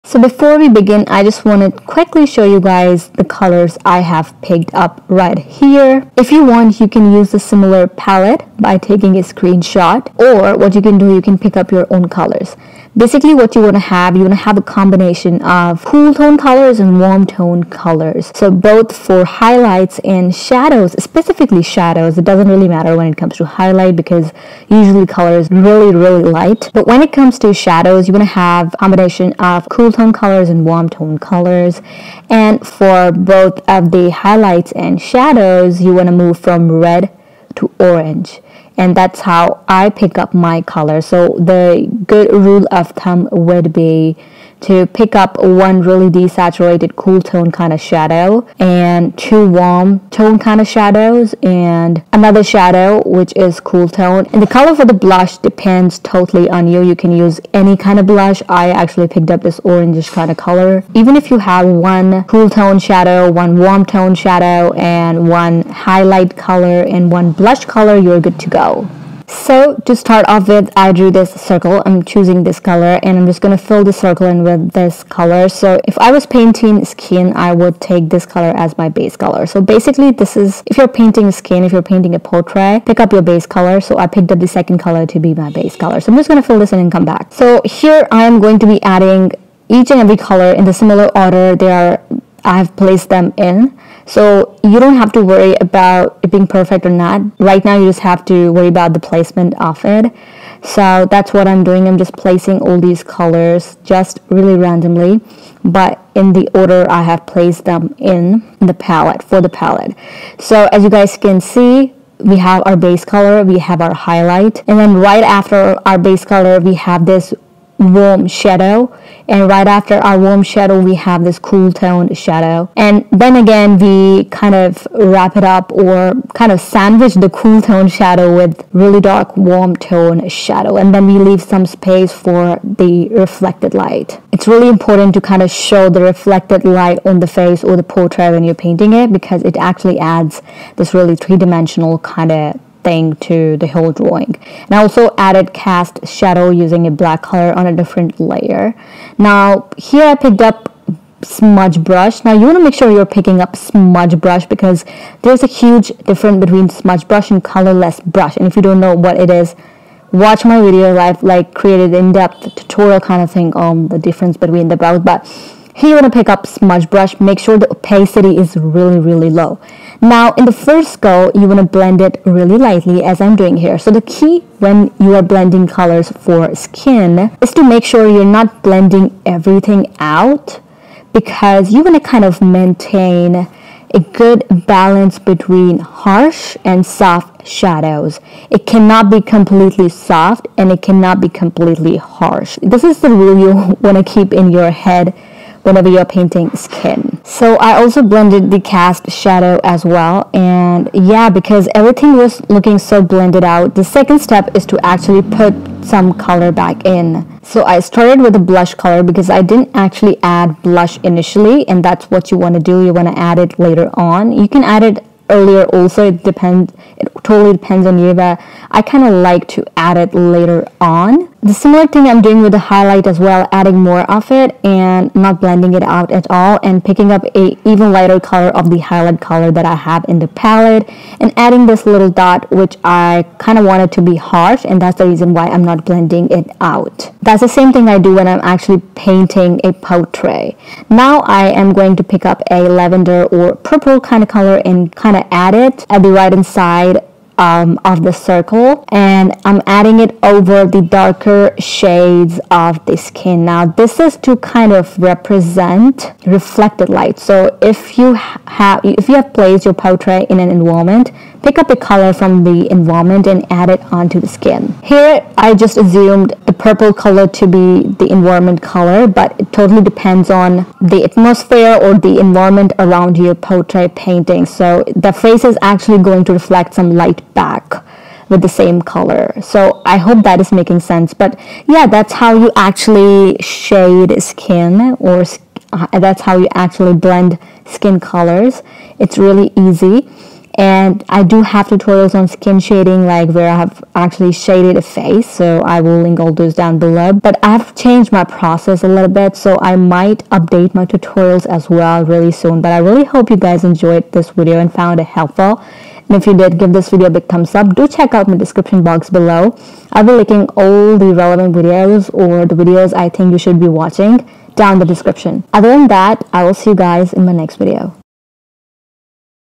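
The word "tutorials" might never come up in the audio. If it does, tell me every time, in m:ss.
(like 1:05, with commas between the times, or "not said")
2:42, 4:51, 5:00.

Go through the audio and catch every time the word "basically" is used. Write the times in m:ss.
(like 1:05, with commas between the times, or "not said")
0:12, 1:19.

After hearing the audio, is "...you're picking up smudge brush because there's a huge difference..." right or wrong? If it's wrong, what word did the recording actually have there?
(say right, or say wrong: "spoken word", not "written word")
right.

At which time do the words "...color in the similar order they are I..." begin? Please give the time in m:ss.
1:30.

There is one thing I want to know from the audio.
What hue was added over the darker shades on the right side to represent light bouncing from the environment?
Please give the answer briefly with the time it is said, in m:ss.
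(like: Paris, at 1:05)
Lavender or purple, at 4:02.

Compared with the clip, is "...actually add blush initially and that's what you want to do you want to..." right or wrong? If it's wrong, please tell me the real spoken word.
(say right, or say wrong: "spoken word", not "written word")
right.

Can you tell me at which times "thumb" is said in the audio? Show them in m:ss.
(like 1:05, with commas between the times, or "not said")
0:42, 5:07.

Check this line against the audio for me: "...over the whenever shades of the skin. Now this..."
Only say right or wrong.
wrong.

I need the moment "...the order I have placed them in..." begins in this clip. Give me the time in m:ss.
1:46.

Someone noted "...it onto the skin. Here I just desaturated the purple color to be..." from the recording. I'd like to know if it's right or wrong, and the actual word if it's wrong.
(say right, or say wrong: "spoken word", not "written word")
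wrong: "assumed", not "desaturated".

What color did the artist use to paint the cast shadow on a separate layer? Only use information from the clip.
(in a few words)
Black.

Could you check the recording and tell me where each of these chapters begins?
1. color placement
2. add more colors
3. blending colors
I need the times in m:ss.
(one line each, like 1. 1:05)
1. 1:09
2. 3:29
3. 2:28.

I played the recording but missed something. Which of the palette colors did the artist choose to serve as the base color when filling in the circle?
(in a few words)
The second color.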